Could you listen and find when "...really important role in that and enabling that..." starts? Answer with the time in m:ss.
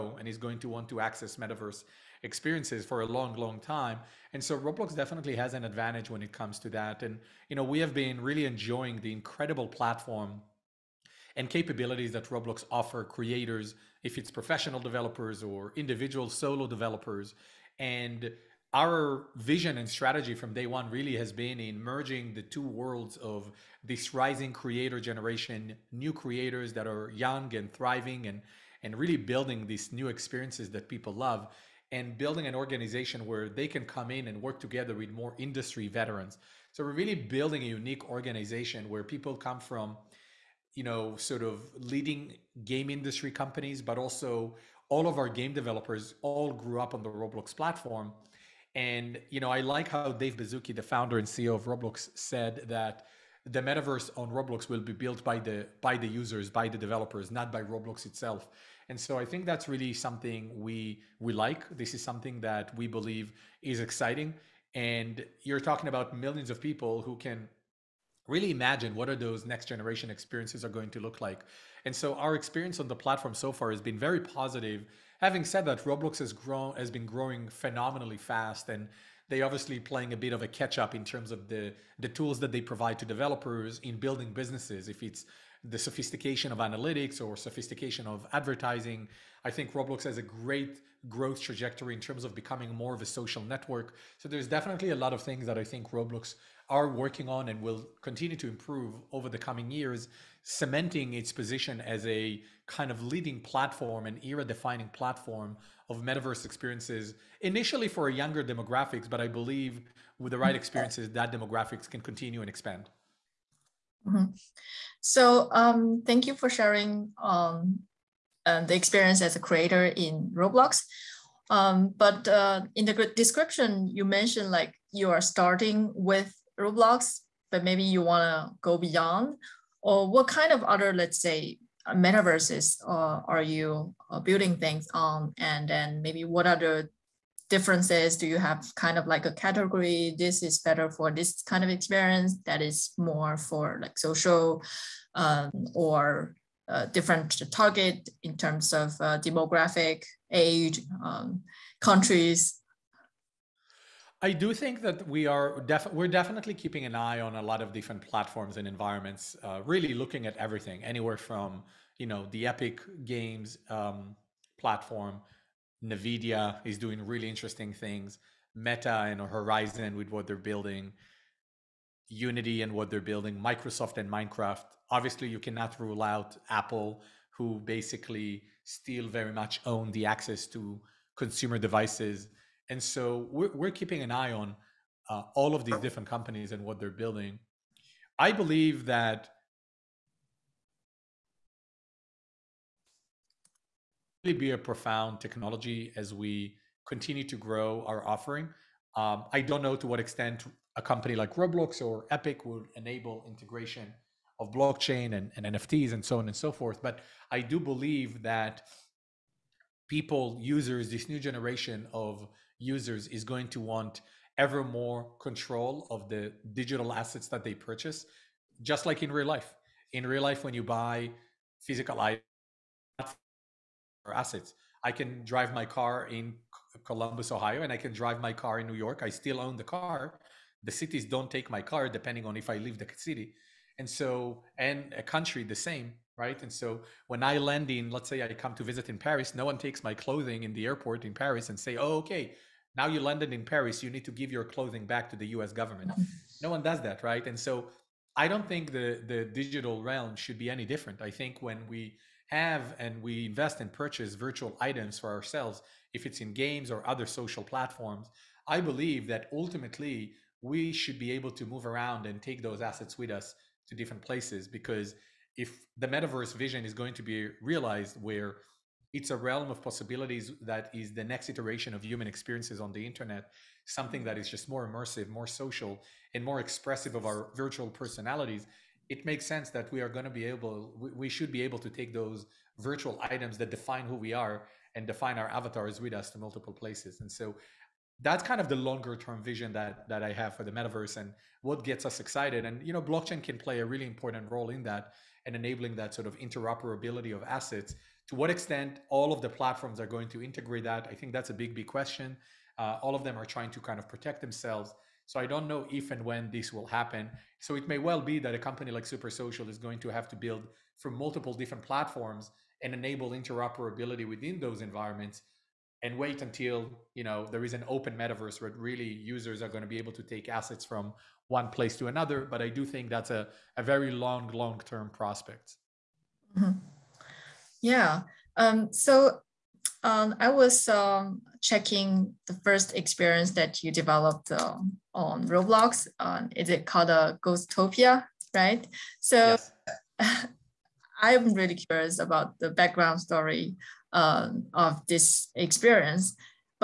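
4:53.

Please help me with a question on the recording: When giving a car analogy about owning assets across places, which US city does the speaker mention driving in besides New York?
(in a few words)
Columbus, Ohio.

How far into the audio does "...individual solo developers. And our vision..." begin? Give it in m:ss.
0:15.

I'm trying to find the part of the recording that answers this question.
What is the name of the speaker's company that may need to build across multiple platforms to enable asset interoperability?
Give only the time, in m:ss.
5:08.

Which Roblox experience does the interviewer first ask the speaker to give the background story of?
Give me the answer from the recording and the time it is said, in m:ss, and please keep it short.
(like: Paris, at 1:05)
Ghostopia, at 5:37.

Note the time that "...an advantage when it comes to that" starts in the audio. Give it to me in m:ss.
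0:05.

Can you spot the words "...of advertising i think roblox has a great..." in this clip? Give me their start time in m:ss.
1:28.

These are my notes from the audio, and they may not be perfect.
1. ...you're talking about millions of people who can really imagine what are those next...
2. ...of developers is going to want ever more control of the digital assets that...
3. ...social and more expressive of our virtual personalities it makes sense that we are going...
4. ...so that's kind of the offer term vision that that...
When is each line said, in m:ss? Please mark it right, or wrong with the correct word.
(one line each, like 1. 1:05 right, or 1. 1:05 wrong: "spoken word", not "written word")
1. 1:05 right
2. 3:31 wrong: "users", not "developers"
3. 4:35 right
4. 4:47 wrong: "longer", not "offer".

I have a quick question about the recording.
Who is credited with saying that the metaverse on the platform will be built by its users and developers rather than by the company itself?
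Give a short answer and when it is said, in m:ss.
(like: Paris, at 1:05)
Dave Baszucki, at 0:50.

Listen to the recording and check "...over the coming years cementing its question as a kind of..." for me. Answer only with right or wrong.
wrong.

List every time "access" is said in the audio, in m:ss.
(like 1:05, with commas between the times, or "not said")
0:01, 3:00.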